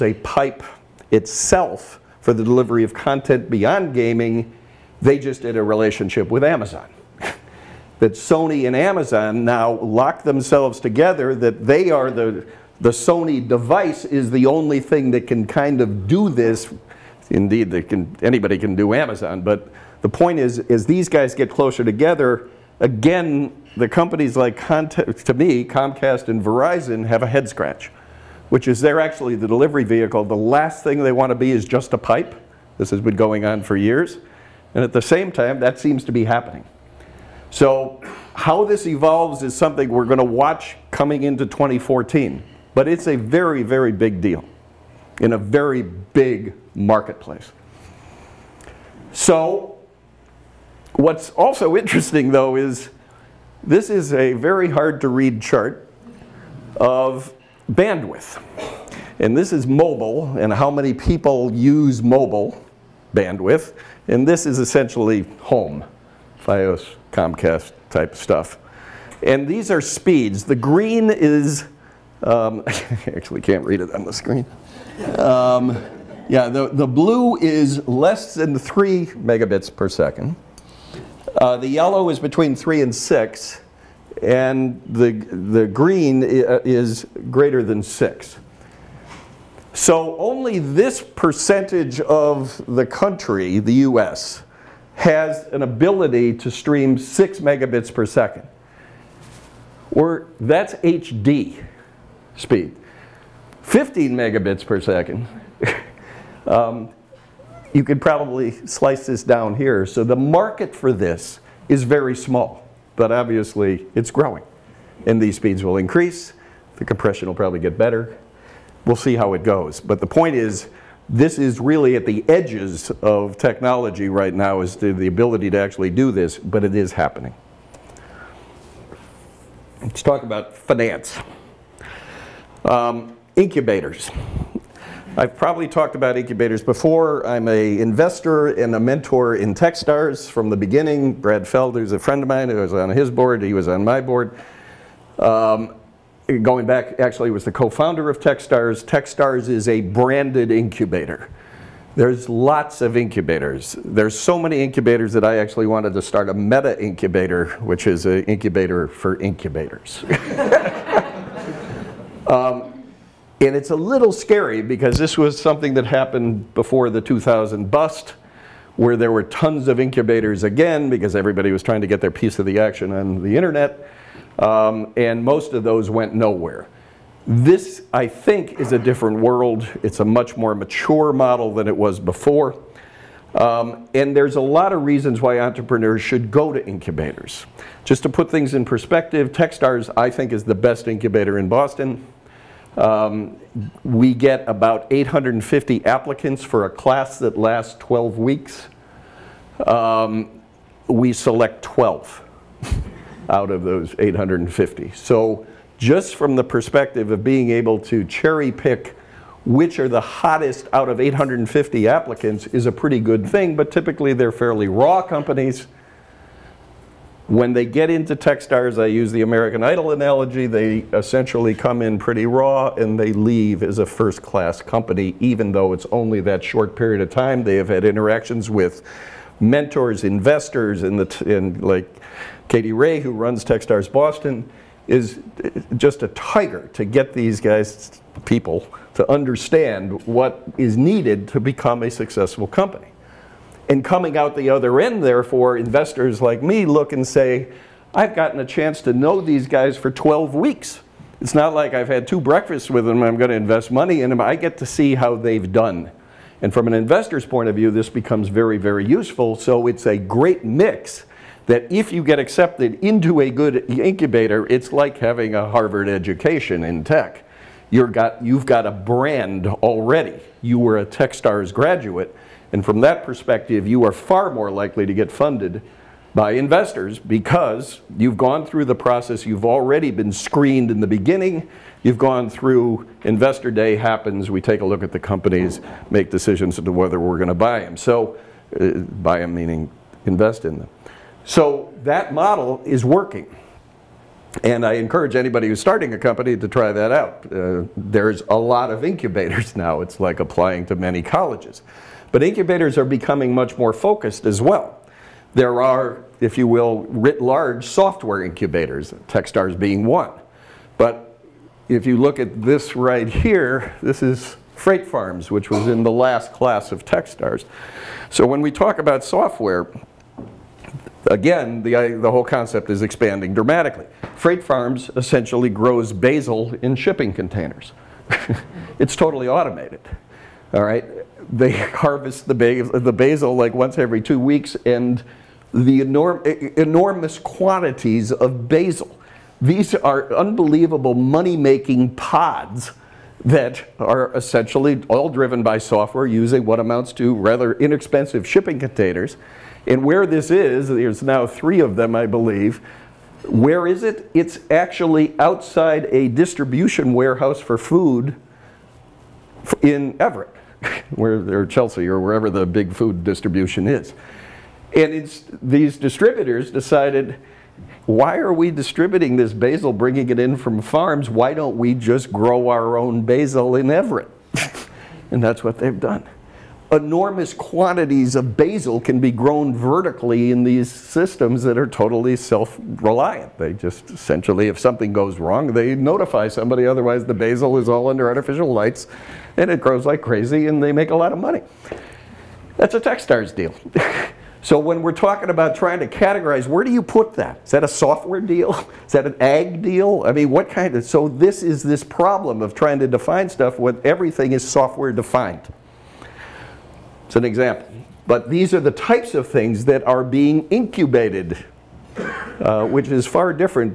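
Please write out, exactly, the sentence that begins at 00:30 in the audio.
The last thing they want to be is just a pipe.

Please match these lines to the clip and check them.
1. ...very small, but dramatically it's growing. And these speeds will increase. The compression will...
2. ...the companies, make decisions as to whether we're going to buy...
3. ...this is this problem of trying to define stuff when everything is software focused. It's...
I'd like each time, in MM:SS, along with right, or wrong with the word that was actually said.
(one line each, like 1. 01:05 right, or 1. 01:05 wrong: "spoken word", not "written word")
1. 01:51 wrong: "obviously", not "dramatically"
2. 04:44 right
3. 06:41 wrong: "defined", not "focused".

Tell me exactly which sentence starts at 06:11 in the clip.
Why don't we just grow our own basil in Everett?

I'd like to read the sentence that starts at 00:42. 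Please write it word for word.
But it's a very, very big deal in a very big marketplace.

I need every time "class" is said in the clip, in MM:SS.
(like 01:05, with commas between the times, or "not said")
03:16, 03:44, 05:16.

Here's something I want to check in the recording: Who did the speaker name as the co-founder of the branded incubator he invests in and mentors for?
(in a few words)
Brad Feld.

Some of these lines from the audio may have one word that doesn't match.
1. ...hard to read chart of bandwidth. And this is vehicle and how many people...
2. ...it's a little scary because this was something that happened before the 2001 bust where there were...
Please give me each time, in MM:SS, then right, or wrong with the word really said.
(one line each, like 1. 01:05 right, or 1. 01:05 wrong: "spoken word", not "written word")
1. 00:54 wrong: "mobile", not "vehicle"
2. 02:43 wrong: "2000", not "2001".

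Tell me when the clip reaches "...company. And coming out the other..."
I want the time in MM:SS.
04:02.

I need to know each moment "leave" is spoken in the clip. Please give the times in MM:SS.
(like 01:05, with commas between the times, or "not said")
03:43.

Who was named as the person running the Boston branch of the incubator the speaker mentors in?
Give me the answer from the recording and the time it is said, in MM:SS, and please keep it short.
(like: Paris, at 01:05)
Katie Rae, at 03:52.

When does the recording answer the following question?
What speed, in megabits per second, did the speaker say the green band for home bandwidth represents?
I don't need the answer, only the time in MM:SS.
01:27.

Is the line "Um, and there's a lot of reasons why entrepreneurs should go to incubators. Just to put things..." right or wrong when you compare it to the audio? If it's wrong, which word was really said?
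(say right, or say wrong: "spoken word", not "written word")
right.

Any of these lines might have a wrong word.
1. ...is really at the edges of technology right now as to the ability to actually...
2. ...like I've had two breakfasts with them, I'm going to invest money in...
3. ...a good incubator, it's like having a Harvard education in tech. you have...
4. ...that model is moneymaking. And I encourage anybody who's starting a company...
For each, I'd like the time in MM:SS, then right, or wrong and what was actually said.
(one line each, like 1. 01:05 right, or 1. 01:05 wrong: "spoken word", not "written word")
1. 02:01 right
2. 04:11 right
3. 04:23 right
4. 04:51 wrong: "working", not "moneymaking".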